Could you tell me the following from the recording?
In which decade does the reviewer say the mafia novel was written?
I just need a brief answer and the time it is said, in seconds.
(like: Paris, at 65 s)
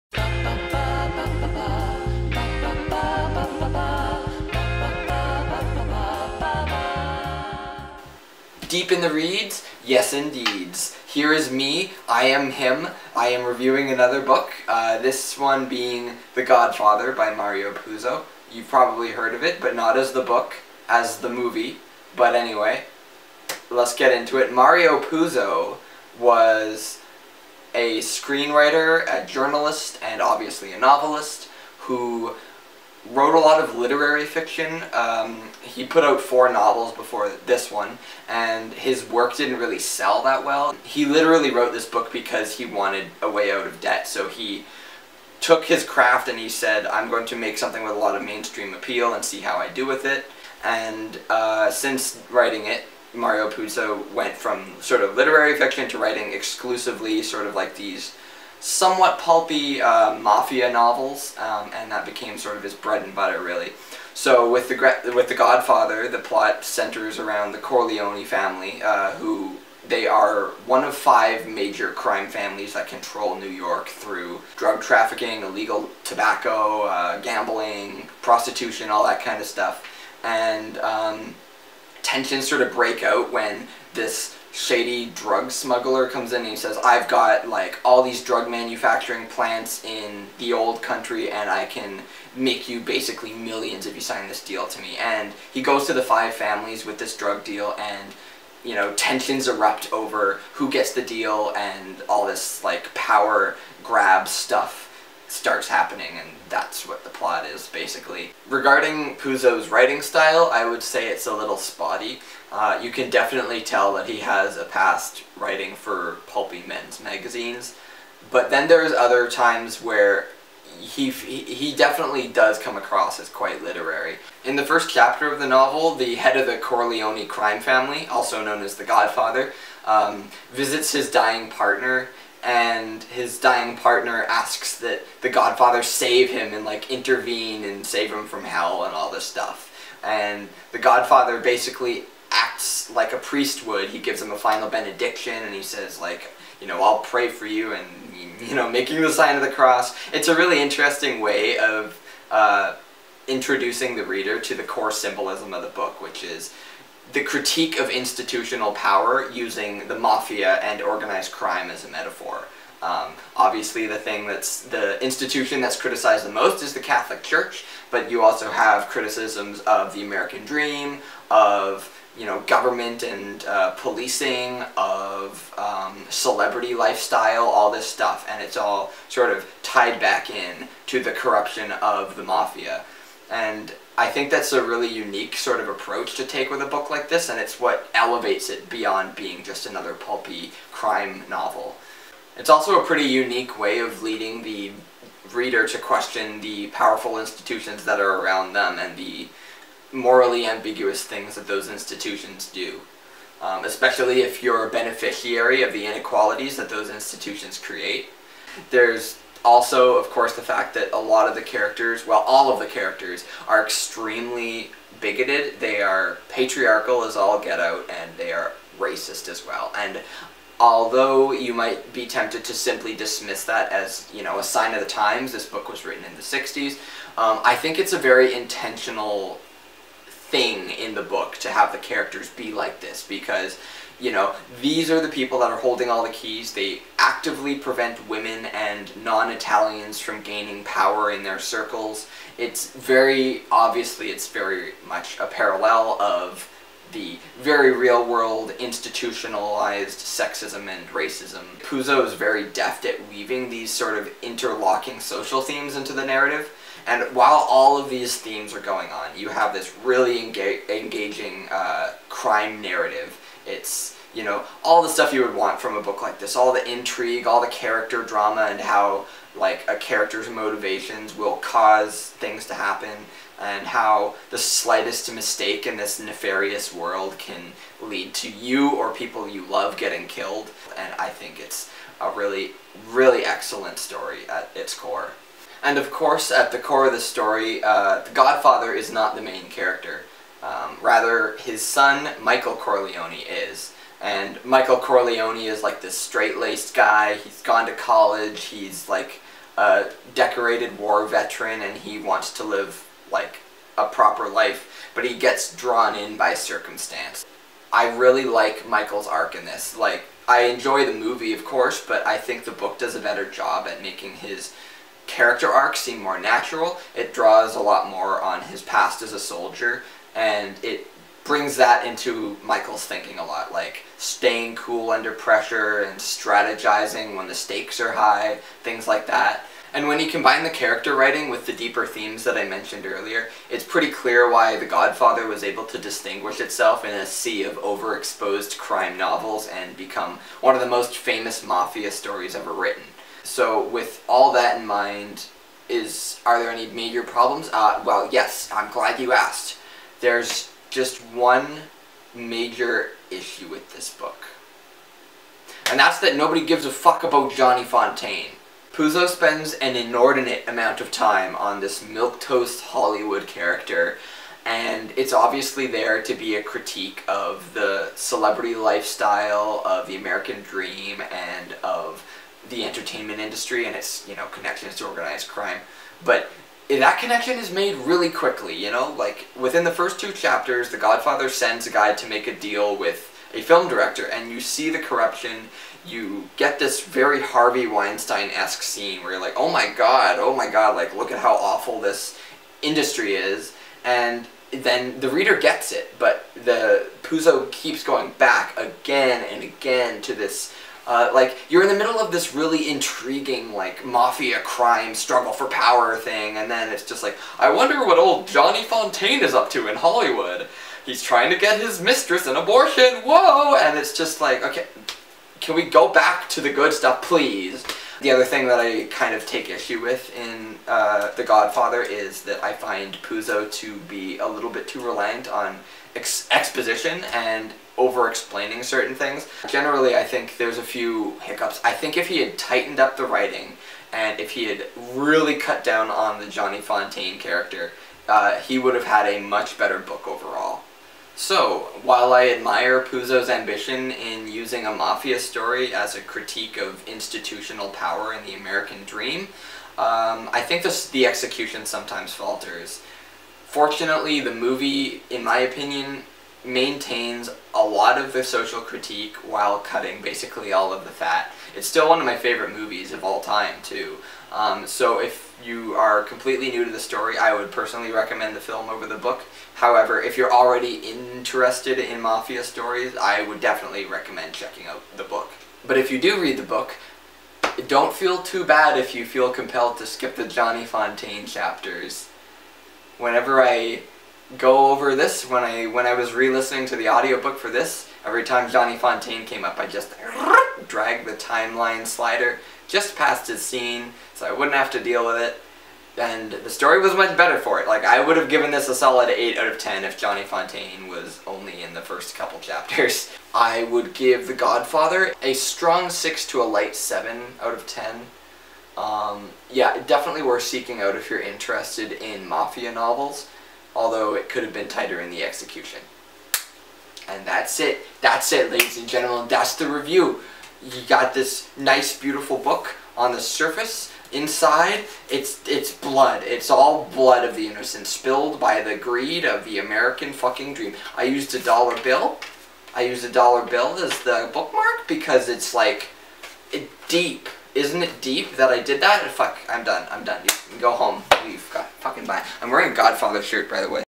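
The 60s, at 226 s.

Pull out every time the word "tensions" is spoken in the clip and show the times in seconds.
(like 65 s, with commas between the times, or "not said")
82 s, 98 s.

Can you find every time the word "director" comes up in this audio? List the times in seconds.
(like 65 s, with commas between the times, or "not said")
383 s.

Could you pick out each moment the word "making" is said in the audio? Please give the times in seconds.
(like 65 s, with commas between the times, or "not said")
148 s, 313 s.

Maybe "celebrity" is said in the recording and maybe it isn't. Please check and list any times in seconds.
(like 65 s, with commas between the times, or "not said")
176 s, 367 s.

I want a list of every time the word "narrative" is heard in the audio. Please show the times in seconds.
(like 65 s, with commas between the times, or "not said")
256 s, 262 s.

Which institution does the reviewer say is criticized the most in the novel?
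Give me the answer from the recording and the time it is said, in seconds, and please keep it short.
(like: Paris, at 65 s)
The Catholic Church, at 166 s.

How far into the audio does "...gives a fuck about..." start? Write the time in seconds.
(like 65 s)
356 s.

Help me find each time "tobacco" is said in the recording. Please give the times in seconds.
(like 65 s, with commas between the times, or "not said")
76 s.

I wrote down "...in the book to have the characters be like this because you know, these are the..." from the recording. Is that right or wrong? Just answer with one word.
right.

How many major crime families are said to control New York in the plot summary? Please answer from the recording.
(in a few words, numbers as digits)
5.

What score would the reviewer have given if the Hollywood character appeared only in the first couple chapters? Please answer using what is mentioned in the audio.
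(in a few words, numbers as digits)
8 out of 10.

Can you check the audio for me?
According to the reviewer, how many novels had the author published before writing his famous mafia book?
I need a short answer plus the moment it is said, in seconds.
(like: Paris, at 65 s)
4, at 36 s.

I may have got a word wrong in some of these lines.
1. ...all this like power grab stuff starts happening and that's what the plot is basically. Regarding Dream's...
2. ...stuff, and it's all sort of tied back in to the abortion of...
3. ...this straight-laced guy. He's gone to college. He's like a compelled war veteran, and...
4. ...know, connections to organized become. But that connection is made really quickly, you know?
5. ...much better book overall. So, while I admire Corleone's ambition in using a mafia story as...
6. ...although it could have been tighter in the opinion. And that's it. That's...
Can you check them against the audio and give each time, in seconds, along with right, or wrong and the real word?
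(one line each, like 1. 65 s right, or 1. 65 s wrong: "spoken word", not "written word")
1. 102 s wrong: "Puzo", not "Dream"
2. 177 s wrong: "corruption", not "abortion"
3. 295 s wrong: "decorated", not "compelled"
4. 374 s wrong: "crime", not "become"
5. 439 s wrong: "Puzo", not "Corleone"
6. 513 s wrong: "execution", not "opinion".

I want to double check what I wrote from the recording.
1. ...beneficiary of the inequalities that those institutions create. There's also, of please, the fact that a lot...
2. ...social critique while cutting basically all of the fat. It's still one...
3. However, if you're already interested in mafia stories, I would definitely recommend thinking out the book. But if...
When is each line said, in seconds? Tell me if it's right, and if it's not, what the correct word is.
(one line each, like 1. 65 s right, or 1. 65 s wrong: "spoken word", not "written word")
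1. 204 s wrong: "course", not "please"
2. 458 s right
3. 469 s wrong: "checking", not "thinking".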